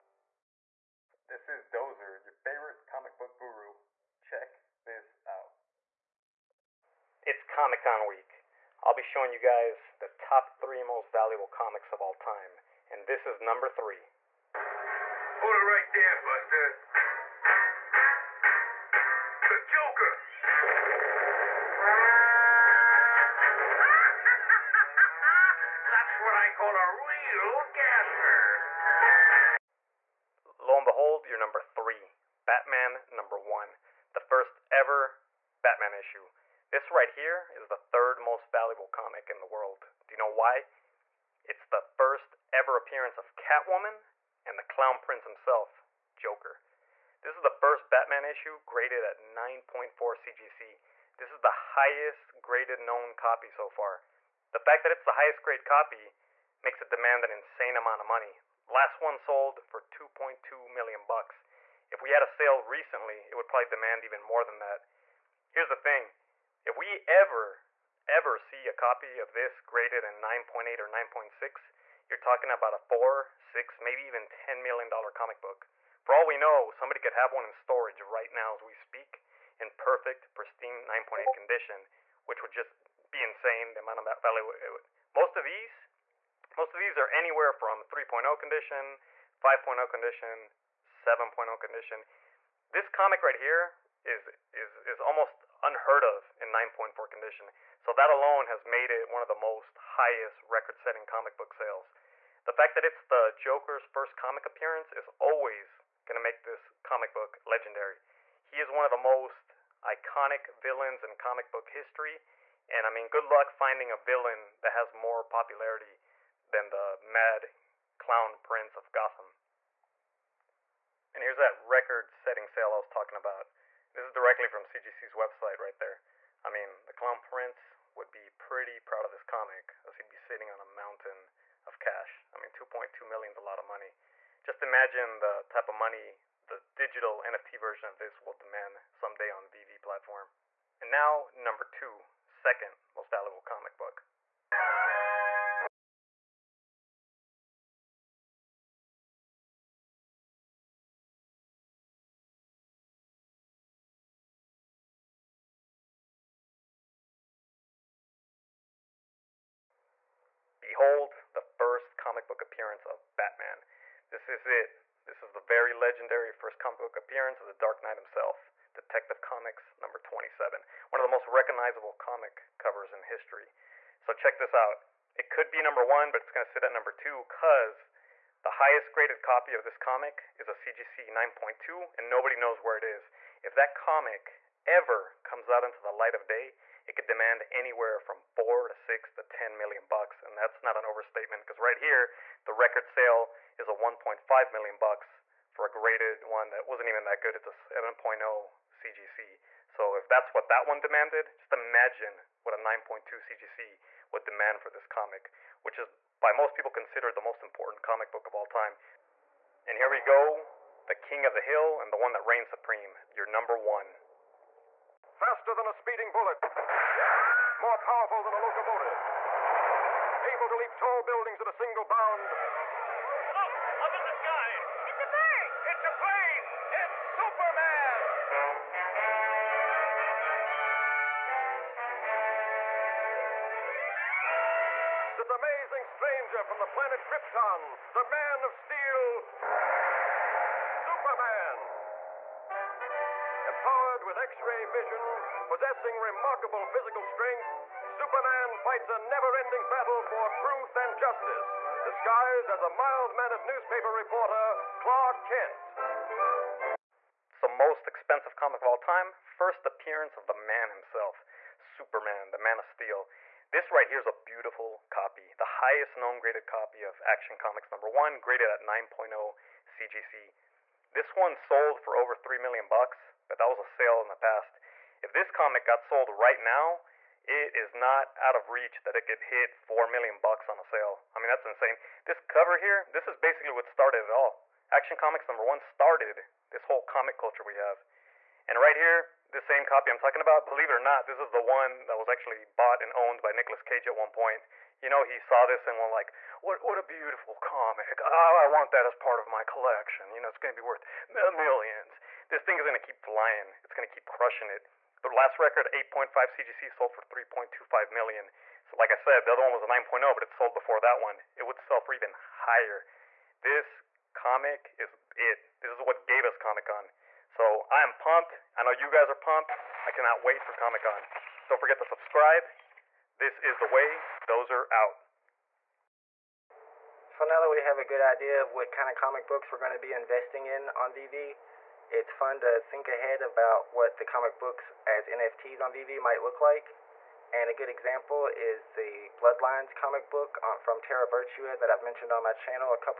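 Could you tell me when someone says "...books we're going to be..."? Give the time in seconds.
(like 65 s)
329 s.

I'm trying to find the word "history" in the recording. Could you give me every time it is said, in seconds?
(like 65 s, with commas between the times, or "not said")
111 s, 173 s.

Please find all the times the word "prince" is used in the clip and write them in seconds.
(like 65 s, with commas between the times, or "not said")
44 s, 118 s, 127 s.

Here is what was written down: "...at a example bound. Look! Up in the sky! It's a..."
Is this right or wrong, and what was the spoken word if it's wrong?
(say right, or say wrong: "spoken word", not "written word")
wrong: "single", not "example".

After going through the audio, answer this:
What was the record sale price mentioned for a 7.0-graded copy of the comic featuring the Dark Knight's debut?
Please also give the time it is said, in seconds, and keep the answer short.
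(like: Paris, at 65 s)
$1.5 million, at 193 s.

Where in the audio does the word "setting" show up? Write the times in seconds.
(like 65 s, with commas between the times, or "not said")
100 s, 122 s.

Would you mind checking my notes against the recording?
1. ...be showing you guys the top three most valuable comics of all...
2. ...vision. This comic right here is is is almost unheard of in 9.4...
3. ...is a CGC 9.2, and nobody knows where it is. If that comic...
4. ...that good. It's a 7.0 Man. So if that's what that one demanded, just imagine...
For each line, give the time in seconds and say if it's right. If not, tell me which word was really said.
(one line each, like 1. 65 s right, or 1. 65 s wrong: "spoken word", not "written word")
1. 8 s right
2. 91 s wrong: "condition", not "vision"
3. 180 s right
4. 197 s wrong: "CGC", not "Man".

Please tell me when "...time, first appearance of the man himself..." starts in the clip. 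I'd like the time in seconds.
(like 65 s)
258 s.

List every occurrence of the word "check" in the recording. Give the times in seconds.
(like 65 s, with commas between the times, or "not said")
4 s, 174 s.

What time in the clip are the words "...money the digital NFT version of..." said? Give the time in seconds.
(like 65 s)
135 s.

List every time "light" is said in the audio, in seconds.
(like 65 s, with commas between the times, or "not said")
185 s.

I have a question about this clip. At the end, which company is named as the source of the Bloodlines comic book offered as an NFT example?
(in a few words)
Terra Virtua.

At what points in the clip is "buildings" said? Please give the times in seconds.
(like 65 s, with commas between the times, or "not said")
221 s.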